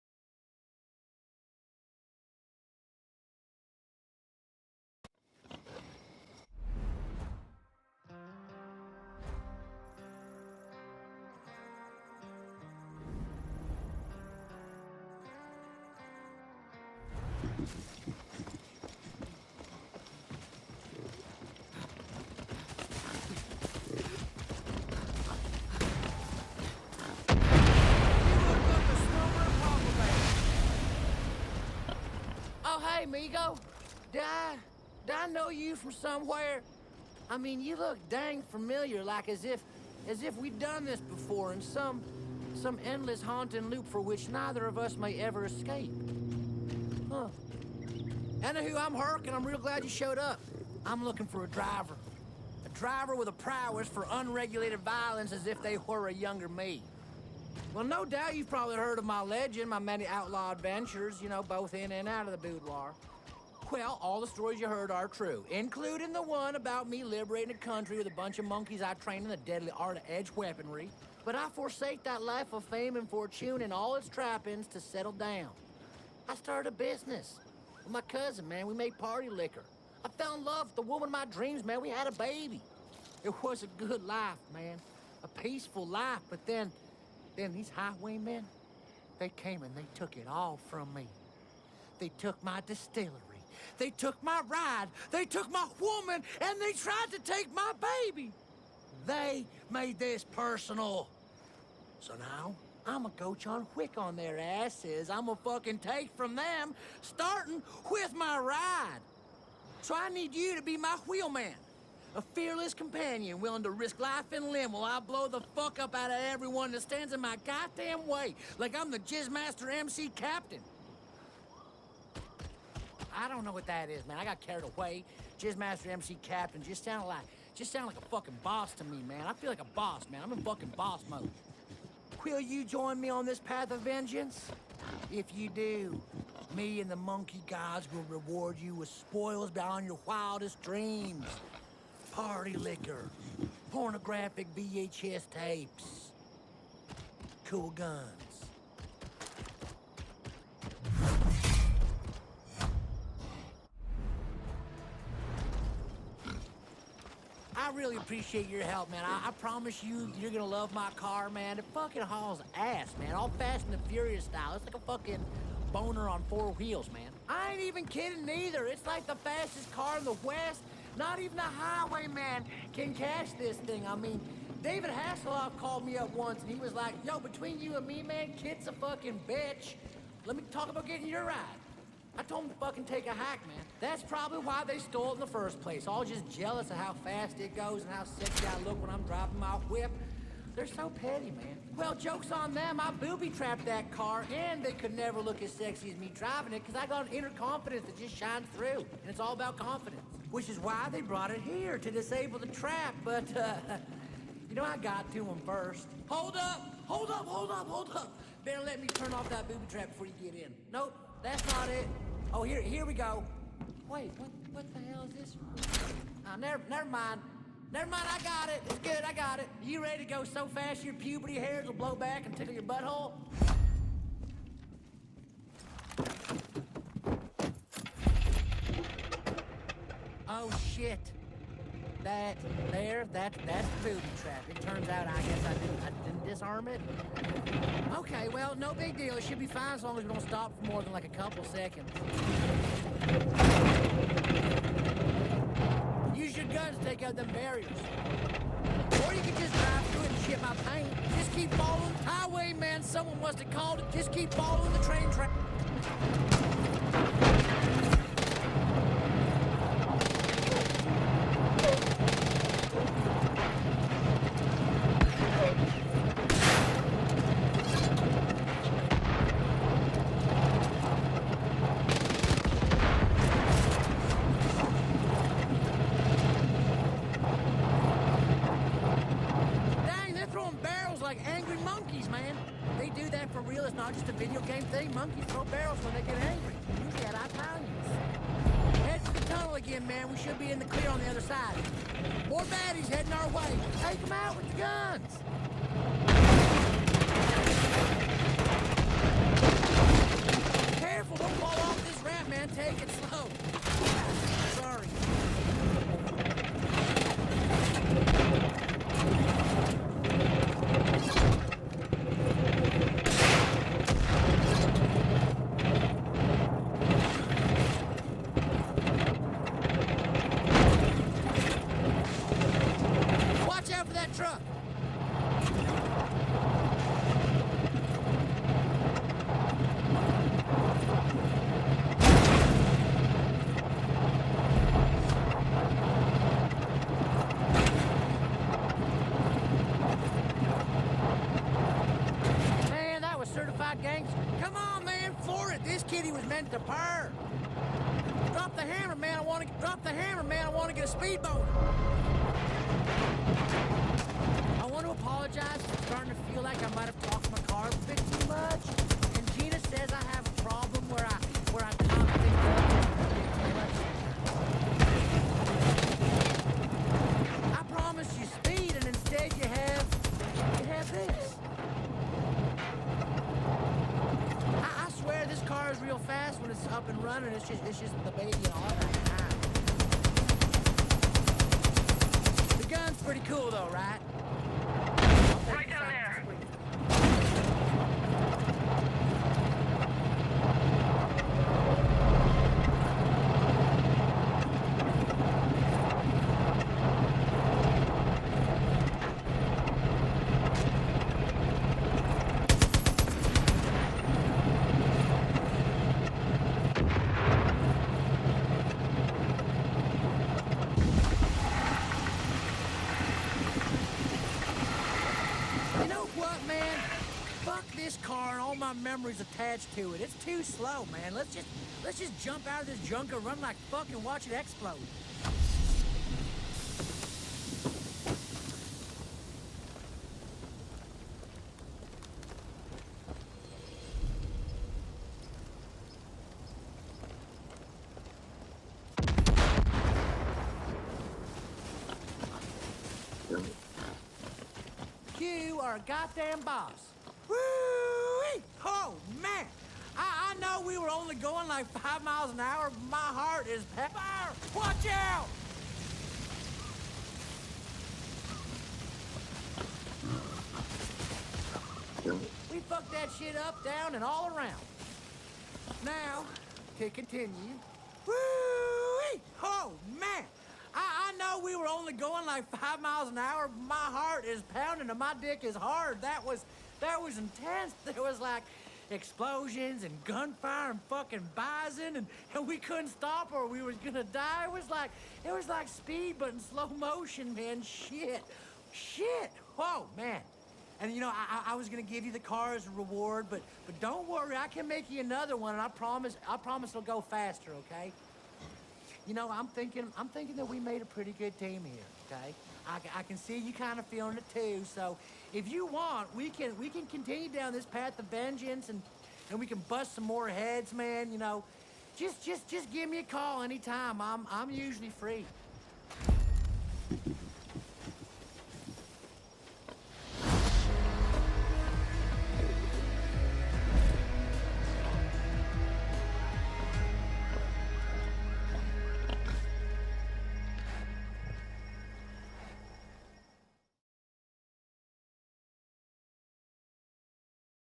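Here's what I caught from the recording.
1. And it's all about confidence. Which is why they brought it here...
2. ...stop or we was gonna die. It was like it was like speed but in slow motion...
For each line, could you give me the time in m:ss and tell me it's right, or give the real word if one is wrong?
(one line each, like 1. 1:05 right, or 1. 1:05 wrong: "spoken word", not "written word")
1. 3:18 right
2. 8:02 right.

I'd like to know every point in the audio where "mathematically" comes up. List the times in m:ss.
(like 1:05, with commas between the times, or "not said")
not said.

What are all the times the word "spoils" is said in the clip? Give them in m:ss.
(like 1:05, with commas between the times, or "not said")
2:18.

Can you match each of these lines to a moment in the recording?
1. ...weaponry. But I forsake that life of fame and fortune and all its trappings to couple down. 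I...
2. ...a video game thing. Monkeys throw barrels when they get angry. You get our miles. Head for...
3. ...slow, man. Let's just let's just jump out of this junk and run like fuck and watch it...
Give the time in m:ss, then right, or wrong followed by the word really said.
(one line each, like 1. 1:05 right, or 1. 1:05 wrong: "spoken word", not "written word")
1. 1:10 wrong: "settle", not "couple"
2. 4:44 wrong: "values", not "miles"
3. 7:00 right.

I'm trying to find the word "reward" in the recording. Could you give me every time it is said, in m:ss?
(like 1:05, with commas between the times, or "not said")
2:18, 8:12.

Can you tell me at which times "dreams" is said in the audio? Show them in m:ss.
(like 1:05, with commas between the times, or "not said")
1:21, 2:20.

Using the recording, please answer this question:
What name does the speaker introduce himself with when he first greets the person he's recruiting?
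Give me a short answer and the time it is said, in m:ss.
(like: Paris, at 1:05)
Hurk, at 0:48.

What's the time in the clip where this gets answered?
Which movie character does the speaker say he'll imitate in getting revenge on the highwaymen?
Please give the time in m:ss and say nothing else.
1:43.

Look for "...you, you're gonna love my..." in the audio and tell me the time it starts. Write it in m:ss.
2:39.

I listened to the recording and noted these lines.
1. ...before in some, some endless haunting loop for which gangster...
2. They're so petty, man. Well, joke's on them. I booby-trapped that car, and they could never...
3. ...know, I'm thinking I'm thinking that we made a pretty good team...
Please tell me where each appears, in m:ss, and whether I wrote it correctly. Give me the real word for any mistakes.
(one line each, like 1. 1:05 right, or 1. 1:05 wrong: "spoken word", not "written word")
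1. 0:40 wrong: "neither", not "gangster"
2. 3:10 right
3. 8:19 right.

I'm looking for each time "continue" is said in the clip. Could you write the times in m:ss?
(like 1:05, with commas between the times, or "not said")
7:46, 8:26.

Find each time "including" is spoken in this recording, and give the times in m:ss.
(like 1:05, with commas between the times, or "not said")
1:05.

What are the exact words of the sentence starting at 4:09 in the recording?
Or you can just drive through and shit my paint.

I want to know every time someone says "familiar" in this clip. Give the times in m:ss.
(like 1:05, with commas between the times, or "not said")
0:38.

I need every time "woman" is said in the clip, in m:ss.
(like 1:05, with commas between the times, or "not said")
1:20, 1:35.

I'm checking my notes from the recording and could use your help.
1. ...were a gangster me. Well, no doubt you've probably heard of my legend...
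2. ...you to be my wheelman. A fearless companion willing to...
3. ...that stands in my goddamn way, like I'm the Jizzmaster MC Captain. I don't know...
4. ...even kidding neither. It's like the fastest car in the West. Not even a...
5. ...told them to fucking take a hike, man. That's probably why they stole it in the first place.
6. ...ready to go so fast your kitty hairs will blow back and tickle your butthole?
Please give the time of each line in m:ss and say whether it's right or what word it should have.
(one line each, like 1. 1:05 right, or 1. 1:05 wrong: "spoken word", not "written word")
1. 0:55 wrong: "younger", not "gangster"
2. 1:50 right
3. 1:56 right
4. 2:47 right
5. 3:02 right
6. 3:39 wrong: "puberty", not "kitty".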